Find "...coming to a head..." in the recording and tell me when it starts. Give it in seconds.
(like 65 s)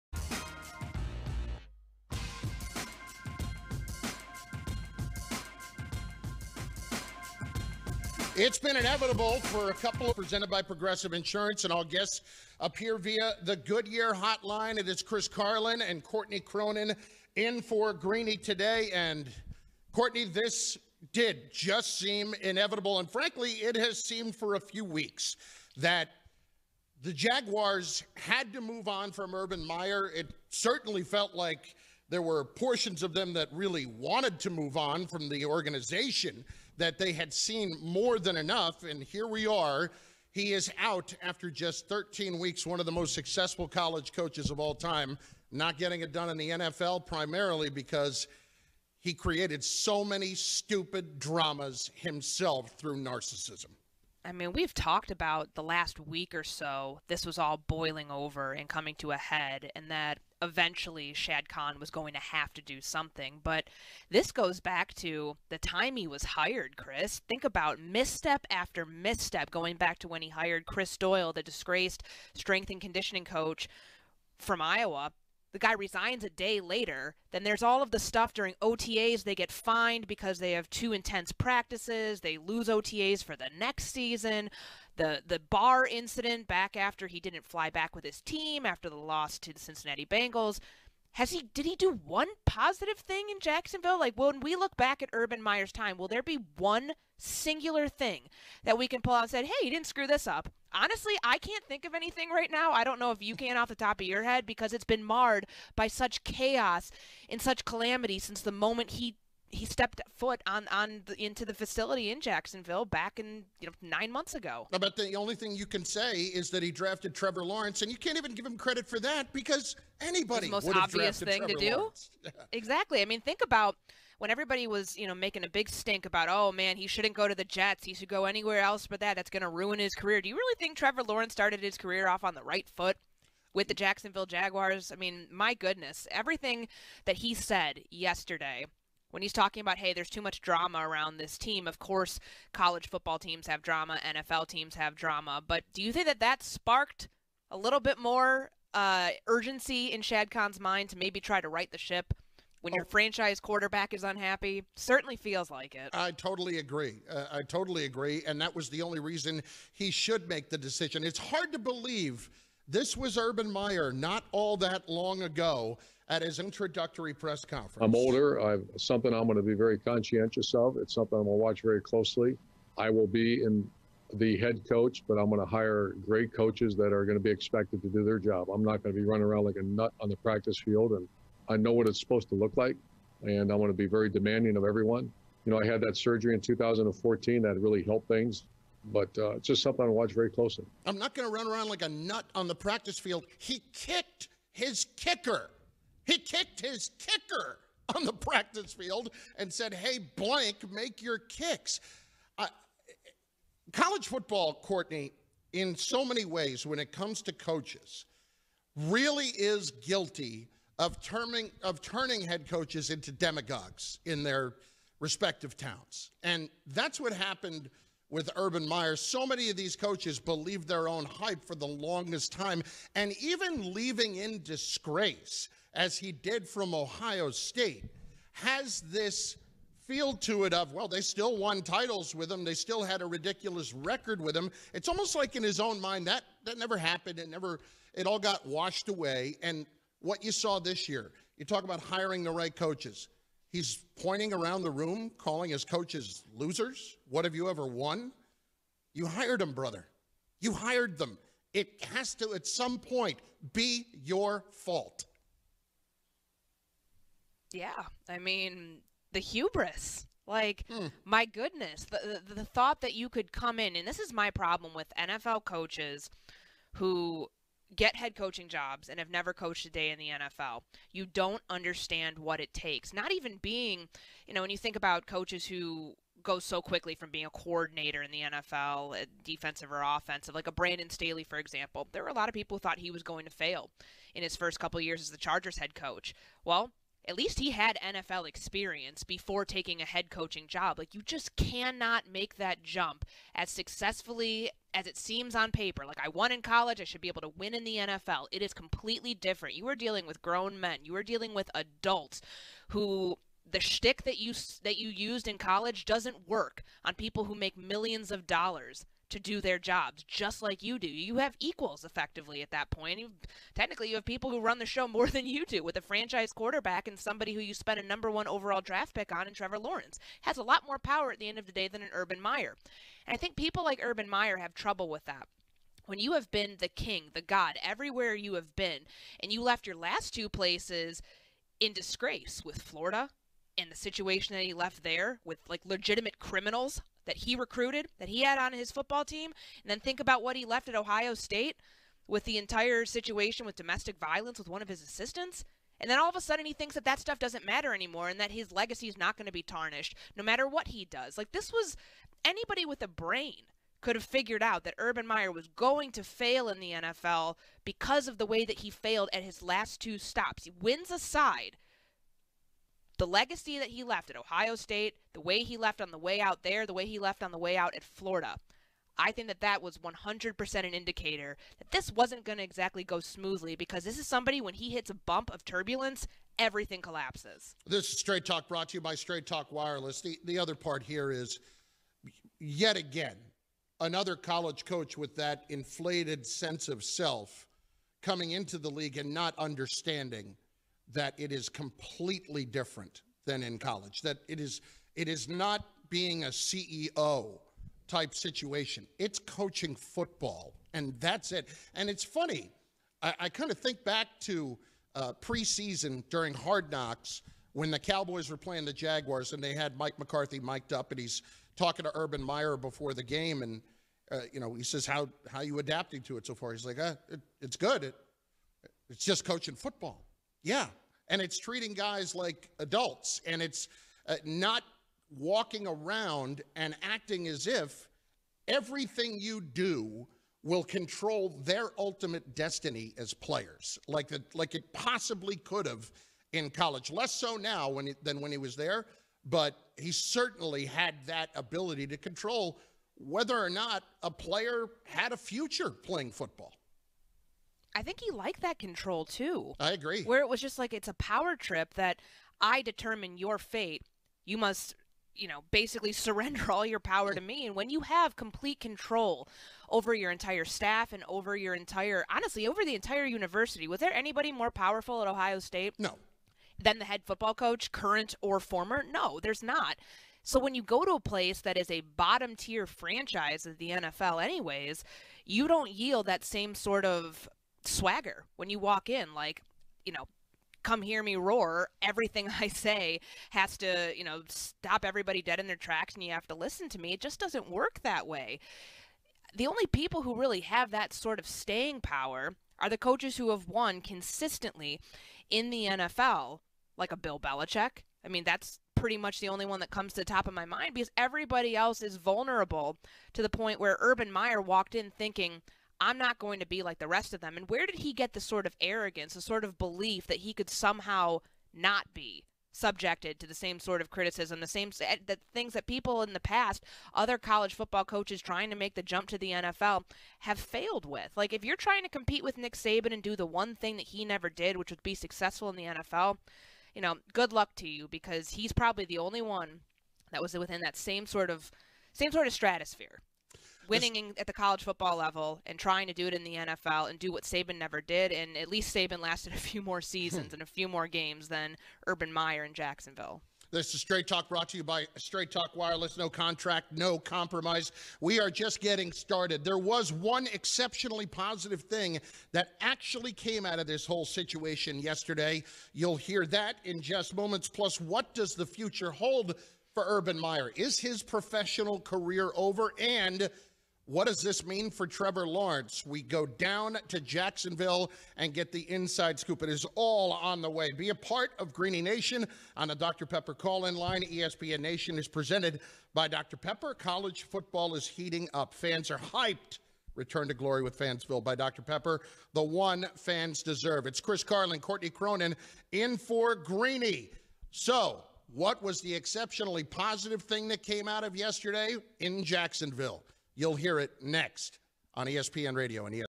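58 s.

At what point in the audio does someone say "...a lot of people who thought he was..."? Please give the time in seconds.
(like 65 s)
282 s.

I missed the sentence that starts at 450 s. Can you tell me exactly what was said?
Where it was just like it's a power trip that I determine your fate.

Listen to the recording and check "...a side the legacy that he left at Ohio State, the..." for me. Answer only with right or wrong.
right.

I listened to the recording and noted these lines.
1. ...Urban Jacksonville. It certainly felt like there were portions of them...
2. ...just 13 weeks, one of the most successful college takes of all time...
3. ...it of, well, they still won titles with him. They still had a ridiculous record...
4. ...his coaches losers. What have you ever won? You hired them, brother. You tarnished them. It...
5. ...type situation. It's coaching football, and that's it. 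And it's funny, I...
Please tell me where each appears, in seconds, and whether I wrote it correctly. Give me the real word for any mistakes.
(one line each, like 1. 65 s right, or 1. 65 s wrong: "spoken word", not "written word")
1. 29 s wrong: "Meyer", not "Jacksonville"
2. 41 s wrong: "coaches", not "takes"
3. 230 s right
4. 245 s wrong: "hired", not "tarnished"
5. 397 s right.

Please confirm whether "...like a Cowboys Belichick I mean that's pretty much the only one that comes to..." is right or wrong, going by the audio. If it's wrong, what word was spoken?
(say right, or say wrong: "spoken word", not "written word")
wrong: "Bill", not "Cowboys".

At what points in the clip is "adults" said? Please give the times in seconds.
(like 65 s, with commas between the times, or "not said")
301 s, 422 s.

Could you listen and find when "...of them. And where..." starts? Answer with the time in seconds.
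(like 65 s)
507 s.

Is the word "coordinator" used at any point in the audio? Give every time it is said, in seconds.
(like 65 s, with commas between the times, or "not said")
277 s.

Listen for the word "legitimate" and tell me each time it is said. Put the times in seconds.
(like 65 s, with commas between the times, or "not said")
335 s.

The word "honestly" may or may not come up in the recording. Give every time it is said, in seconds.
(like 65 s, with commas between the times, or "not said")
100 s, 462 s.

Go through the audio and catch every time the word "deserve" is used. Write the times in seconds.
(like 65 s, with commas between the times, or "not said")
583 s.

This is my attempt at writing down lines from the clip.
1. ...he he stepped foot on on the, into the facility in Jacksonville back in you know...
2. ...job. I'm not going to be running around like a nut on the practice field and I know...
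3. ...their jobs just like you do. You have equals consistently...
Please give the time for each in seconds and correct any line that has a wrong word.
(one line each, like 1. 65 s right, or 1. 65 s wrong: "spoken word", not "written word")
1. 108 s right
2. 178 s right
3. 309 s wrong: "effectively", not "consistently".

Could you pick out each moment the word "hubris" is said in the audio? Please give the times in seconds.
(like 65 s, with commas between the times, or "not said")
259 s.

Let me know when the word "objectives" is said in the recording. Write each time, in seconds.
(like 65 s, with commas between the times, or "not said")
not said.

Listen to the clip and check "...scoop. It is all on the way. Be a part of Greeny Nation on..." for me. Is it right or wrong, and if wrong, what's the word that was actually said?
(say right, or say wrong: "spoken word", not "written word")
right.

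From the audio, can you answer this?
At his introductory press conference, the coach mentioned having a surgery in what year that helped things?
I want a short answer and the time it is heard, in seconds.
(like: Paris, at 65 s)
2014, at 186 s.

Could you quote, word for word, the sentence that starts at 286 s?
Well, at least he had NFL experience before taking a head coaching job.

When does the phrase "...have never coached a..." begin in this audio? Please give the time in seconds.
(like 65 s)
268 s.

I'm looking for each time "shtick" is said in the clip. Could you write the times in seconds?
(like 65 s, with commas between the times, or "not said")
303 s.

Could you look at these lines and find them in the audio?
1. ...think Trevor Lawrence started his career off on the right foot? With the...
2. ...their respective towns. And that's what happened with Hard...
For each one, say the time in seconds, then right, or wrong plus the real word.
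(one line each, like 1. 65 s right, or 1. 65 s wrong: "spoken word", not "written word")
1. 130 s right
2. 214 s wrong: "Urban", not "Hard".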